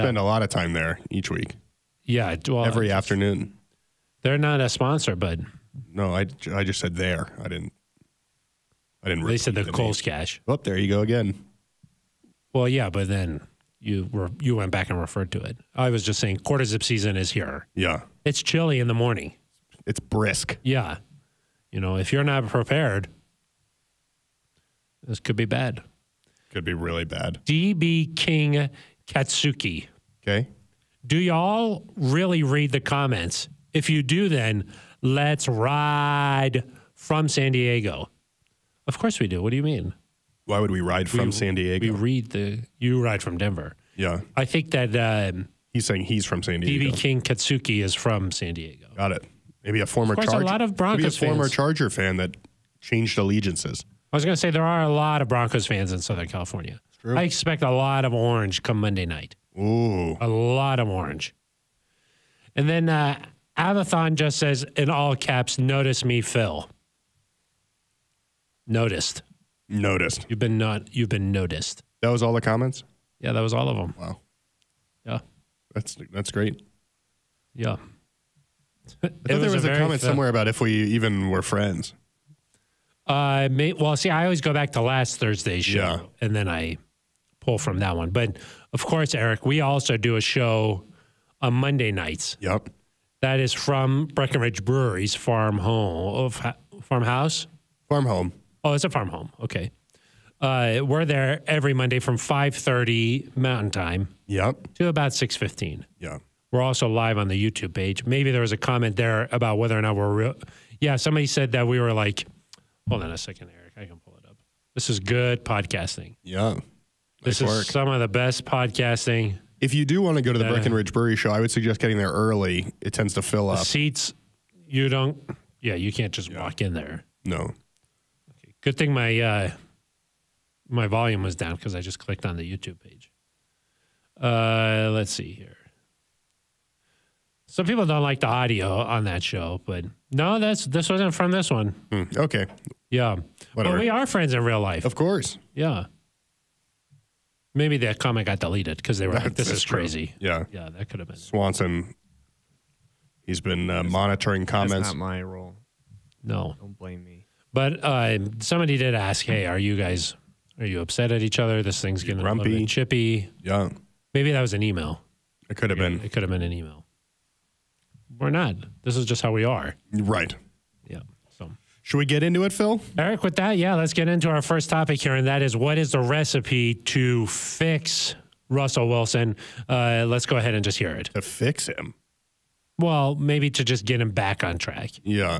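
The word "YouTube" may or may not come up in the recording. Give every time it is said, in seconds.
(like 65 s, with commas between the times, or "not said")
107 s, 132 s.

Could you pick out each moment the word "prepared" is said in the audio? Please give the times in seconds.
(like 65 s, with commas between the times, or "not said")
22 s.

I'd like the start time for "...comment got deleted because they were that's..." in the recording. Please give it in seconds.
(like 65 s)
147 s.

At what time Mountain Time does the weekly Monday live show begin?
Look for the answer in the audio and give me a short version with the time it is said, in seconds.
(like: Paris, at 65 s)
5:30, at 102 s.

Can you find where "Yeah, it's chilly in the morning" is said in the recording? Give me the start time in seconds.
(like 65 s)
17 s.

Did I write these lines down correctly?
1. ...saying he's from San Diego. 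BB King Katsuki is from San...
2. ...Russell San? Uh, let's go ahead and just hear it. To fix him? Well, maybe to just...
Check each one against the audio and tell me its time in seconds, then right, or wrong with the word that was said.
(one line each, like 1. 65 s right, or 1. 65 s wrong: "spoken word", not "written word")
1. 45 s right
2. 178 s wrong: "Wilson", not "San".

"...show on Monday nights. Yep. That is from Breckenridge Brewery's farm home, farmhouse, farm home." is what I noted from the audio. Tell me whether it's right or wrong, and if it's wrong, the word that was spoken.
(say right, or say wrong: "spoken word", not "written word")
right.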